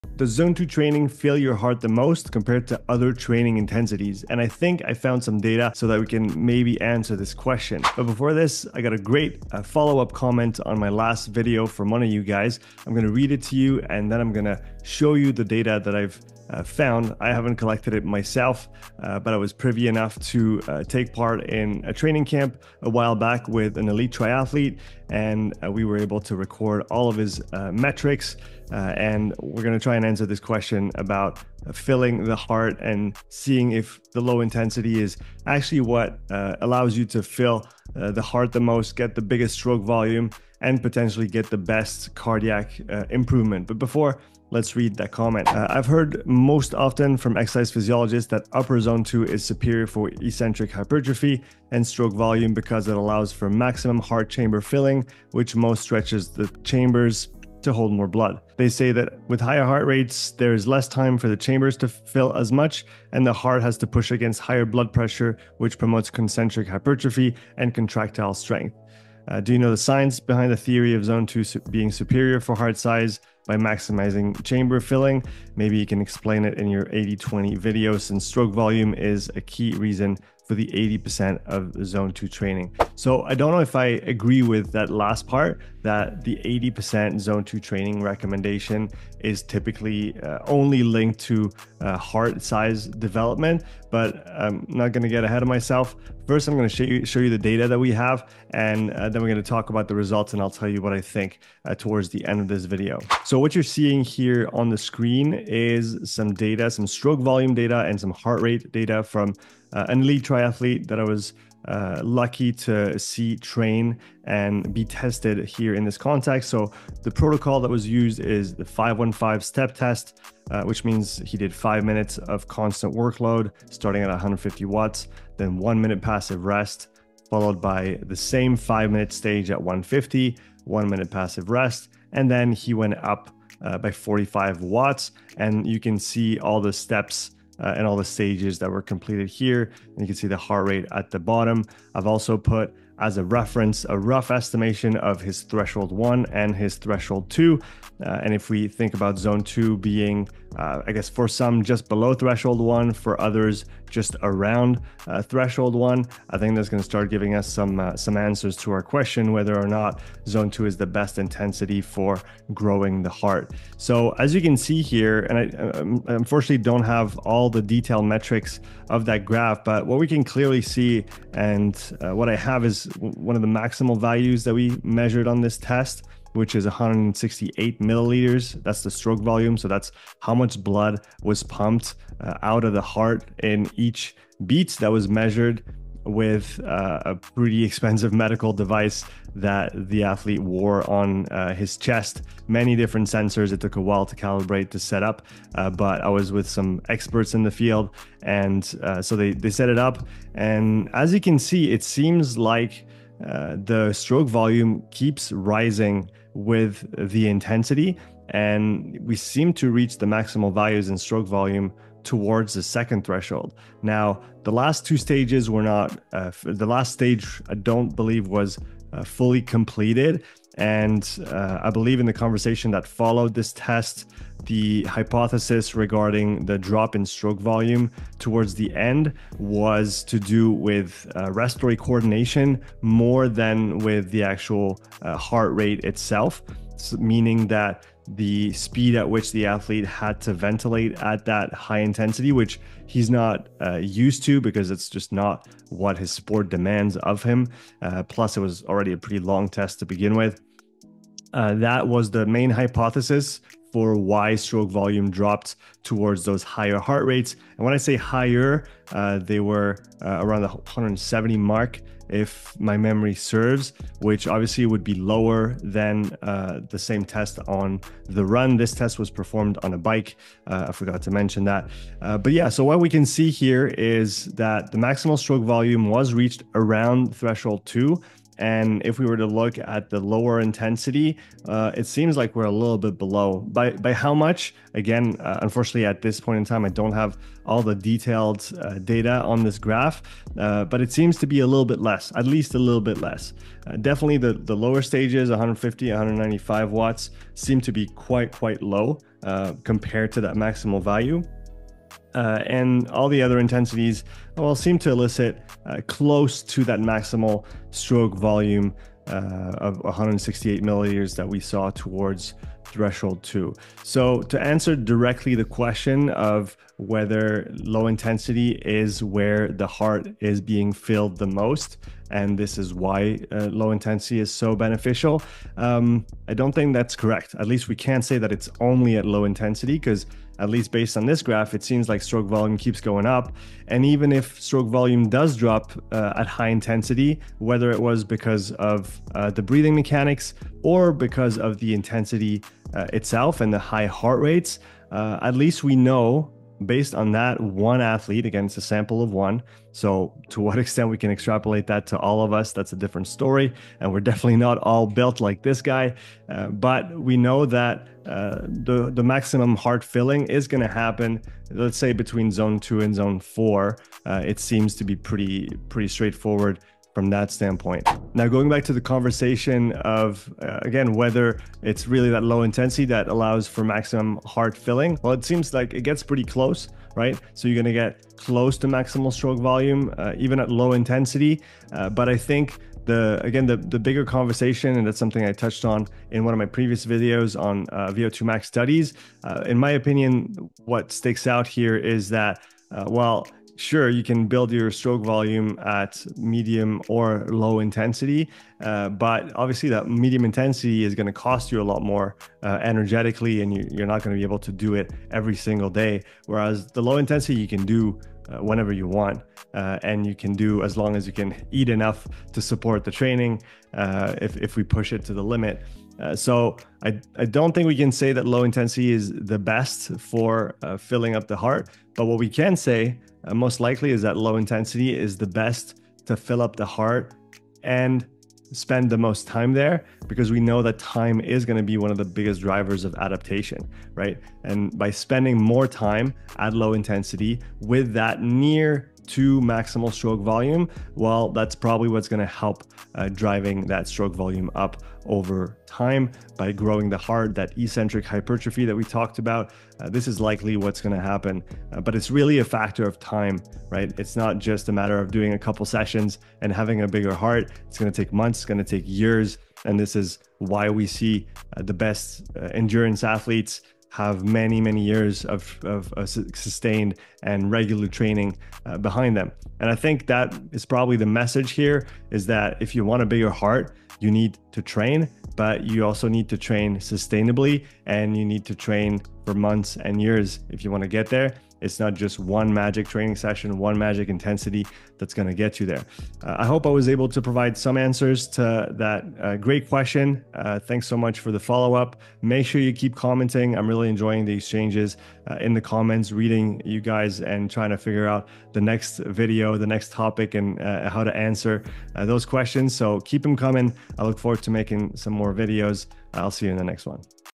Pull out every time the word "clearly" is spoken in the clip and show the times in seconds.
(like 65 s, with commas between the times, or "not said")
170 s.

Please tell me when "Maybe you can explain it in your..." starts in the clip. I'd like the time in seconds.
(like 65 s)
75 s.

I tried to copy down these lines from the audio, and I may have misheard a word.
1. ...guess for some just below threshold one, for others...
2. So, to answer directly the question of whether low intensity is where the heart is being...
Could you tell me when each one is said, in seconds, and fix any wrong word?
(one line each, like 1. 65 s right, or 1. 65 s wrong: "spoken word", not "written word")
1. 150 s right
2. 313 s right.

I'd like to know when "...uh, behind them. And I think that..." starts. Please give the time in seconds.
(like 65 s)
468 s.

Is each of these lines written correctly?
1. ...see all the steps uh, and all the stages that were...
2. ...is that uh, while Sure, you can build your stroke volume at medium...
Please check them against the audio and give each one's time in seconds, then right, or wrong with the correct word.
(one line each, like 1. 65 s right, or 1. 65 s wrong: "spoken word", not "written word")
1. 135 s right
2. 391 s right.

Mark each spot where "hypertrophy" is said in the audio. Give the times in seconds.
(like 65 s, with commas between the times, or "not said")
50 s, 66 s, 448 s.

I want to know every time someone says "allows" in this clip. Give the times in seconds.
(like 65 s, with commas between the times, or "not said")
36 s, 52 s, 373 s.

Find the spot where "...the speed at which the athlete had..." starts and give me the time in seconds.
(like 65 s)
238 s.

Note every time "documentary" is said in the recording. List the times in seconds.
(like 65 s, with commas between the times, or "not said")
not said.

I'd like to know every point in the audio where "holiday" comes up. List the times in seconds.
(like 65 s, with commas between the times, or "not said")
not said.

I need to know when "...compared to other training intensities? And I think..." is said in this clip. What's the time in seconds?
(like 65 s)
2 s.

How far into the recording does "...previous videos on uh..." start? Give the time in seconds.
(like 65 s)
386 s.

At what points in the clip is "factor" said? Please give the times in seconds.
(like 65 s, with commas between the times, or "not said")
452 s.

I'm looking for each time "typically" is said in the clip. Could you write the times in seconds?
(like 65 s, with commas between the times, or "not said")
89 s.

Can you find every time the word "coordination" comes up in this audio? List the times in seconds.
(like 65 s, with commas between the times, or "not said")
231 s.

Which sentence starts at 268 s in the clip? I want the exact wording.
This test was performed on a bike.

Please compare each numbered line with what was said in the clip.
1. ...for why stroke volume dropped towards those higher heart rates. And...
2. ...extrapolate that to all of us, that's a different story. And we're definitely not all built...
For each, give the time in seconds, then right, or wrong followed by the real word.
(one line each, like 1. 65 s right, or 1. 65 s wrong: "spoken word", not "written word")
1. 253 s right
2. 351 s right.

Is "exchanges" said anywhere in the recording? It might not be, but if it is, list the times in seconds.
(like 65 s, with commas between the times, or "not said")
494 s.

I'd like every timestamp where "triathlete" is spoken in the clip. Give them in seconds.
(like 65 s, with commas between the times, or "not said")
24 s, 110 s.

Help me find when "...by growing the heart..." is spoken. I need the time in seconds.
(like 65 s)
446 s.